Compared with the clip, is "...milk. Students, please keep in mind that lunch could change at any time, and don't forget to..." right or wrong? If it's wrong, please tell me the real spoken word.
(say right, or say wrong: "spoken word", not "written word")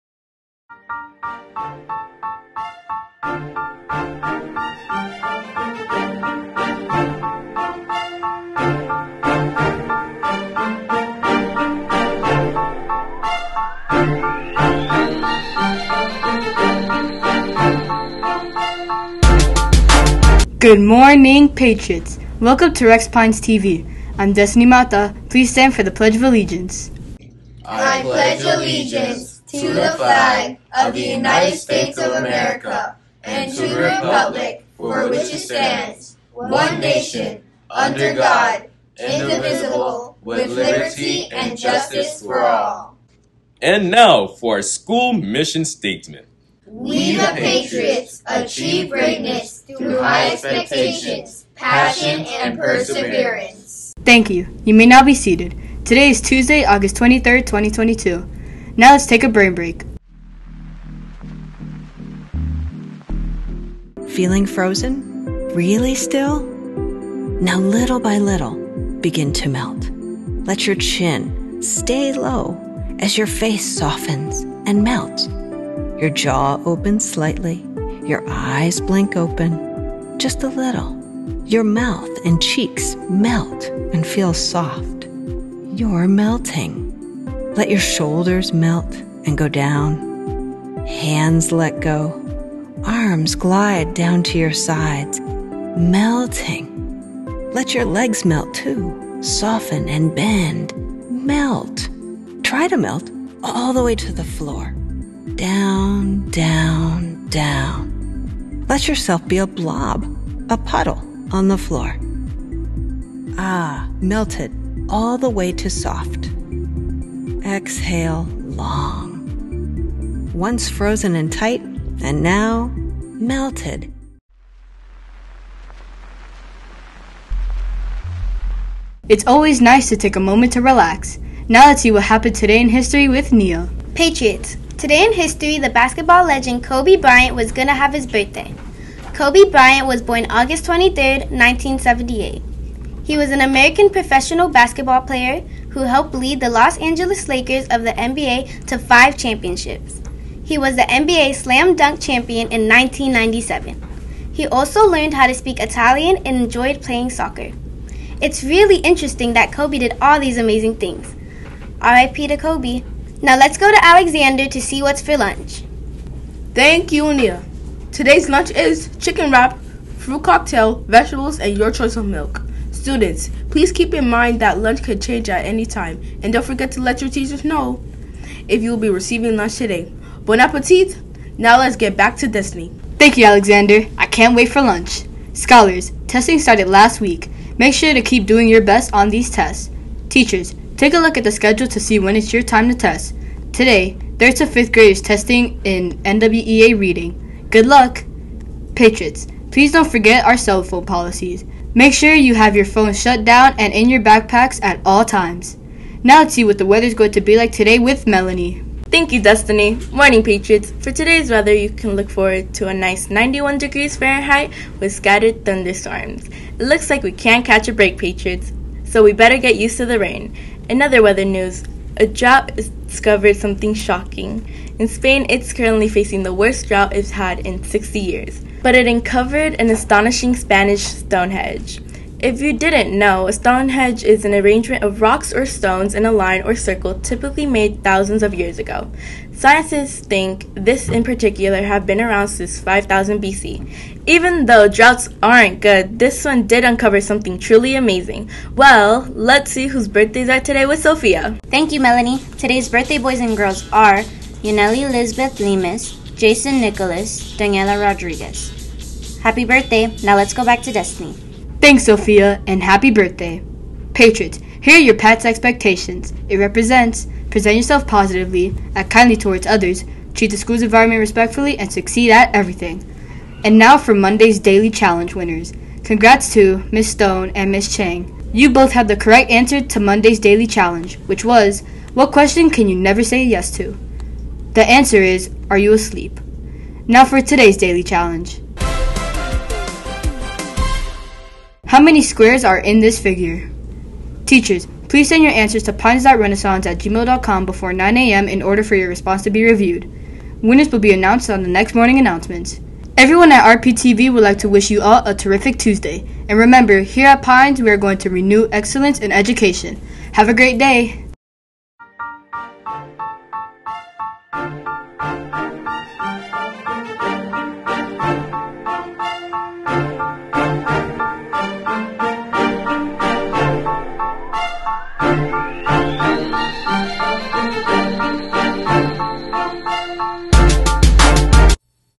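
right.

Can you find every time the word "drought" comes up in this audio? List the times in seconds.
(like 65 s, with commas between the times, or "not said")
226 s, 244 s.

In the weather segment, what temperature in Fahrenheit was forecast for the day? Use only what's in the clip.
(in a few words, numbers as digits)
91 degrees.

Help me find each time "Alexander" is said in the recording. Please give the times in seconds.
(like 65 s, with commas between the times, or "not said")
163 s, 183 s.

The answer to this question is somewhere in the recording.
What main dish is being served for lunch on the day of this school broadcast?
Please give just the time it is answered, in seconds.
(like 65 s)
168 s.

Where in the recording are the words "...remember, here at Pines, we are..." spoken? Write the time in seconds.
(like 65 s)
306 s.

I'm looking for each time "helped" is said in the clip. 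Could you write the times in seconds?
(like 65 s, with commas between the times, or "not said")
145 s.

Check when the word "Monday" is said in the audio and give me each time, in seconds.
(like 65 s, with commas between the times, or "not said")
273 s, 279 s.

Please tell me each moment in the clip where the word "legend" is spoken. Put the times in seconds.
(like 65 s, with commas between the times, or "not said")
136 s.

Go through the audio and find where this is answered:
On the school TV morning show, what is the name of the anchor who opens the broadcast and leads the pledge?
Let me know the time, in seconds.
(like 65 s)
24 s.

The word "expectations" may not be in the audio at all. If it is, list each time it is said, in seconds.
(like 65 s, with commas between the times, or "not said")
50 s, 265 s.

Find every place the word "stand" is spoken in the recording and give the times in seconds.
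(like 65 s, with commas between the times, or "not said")
25 s, 35 s.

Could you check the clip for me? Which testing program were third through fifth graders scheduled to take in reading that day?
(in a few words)
NWEA.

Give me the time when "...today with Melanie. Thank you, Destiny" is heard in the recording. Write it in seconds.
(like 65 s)
207 s.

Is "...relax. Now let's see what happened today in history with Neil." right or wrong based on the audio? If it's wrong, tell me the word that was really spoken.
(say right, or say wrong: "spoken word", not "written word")
right.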